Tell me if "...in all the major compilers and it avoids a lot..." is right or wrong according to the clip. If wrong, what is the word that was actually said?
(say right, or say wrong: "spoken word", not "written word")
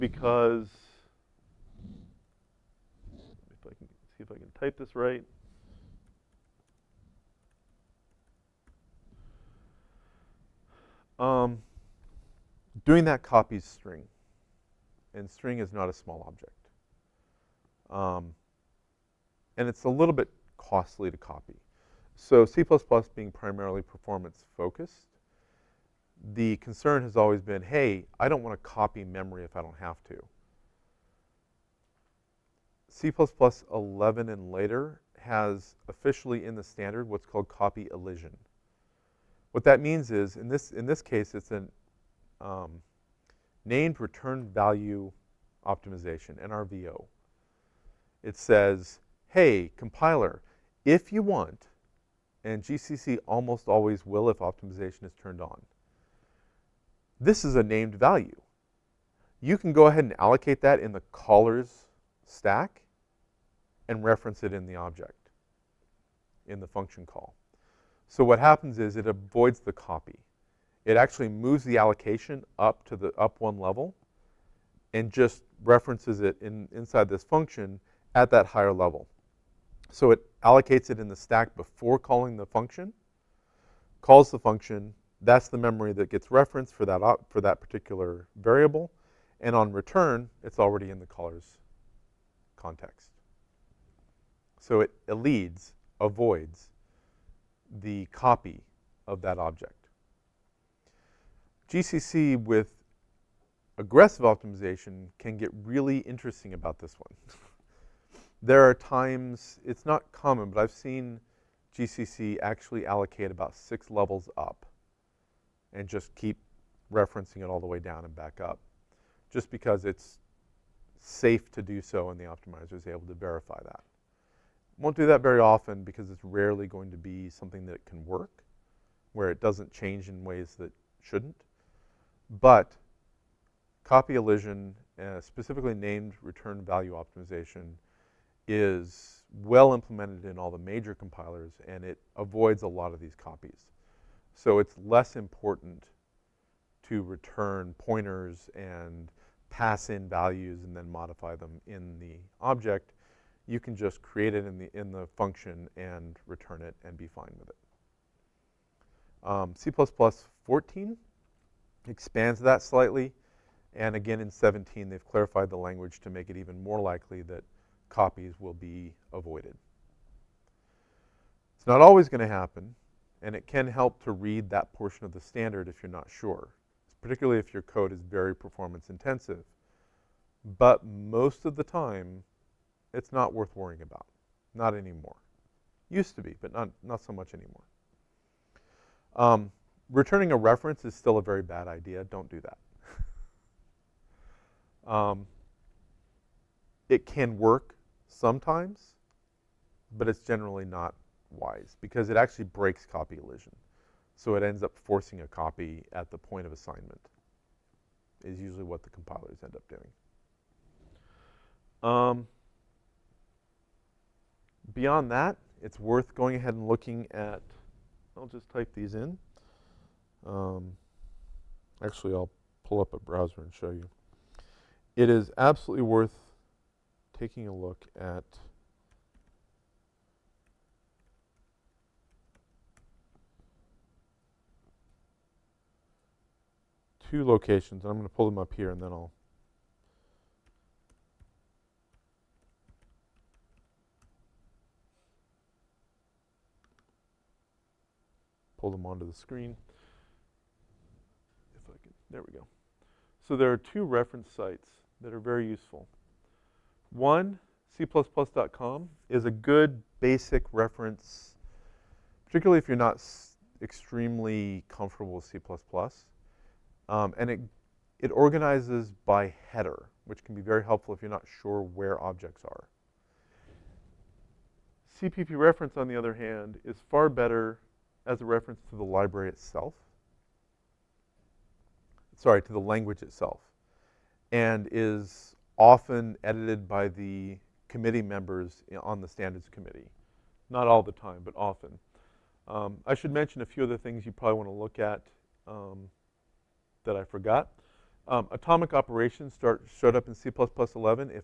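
right.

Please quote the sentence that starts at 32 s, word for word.
C++ 11 and later has officially in the standard what's called copy elision.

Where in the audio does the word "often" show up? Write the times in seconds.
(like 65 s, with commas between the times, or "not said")
125 s, 285 s, 291 s.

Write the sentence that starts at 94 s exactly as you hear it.
So it leads avoids, the copy of that object.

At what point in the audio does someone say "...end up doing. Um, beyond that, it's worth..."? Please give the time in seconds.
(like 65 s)
209 s.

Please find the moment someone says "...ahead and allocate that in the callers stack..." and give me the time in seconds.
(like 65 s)
59 s.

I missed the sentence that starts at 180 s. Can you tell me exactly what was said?
But most of the time, it's not worth worrying about.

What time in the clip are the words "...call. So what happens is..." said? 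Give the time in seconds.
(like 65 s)
67 s.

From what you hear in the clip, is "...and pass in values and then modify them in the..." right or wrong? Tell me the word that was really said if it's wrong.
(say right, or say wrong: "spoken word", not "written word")
right.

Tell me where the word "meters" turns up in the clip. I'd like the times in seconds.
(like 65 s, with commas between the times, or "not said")
not said.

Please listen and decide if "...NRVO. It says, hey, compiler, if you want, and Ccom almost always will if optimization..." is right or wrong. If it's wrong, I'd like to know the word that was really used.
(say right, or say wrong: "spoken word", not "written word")
wrong: "GCC", not "Ccom".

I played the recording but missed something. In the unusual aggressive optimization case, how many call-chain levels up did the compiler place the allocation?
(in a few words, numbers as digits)
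6.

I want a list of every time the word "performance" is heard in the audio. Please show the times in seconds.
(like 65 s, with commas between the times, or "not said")
23 s, 178 s.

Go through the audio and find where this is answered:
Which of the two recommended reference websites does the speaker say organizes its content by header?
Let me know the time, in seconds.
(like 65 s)
257 s.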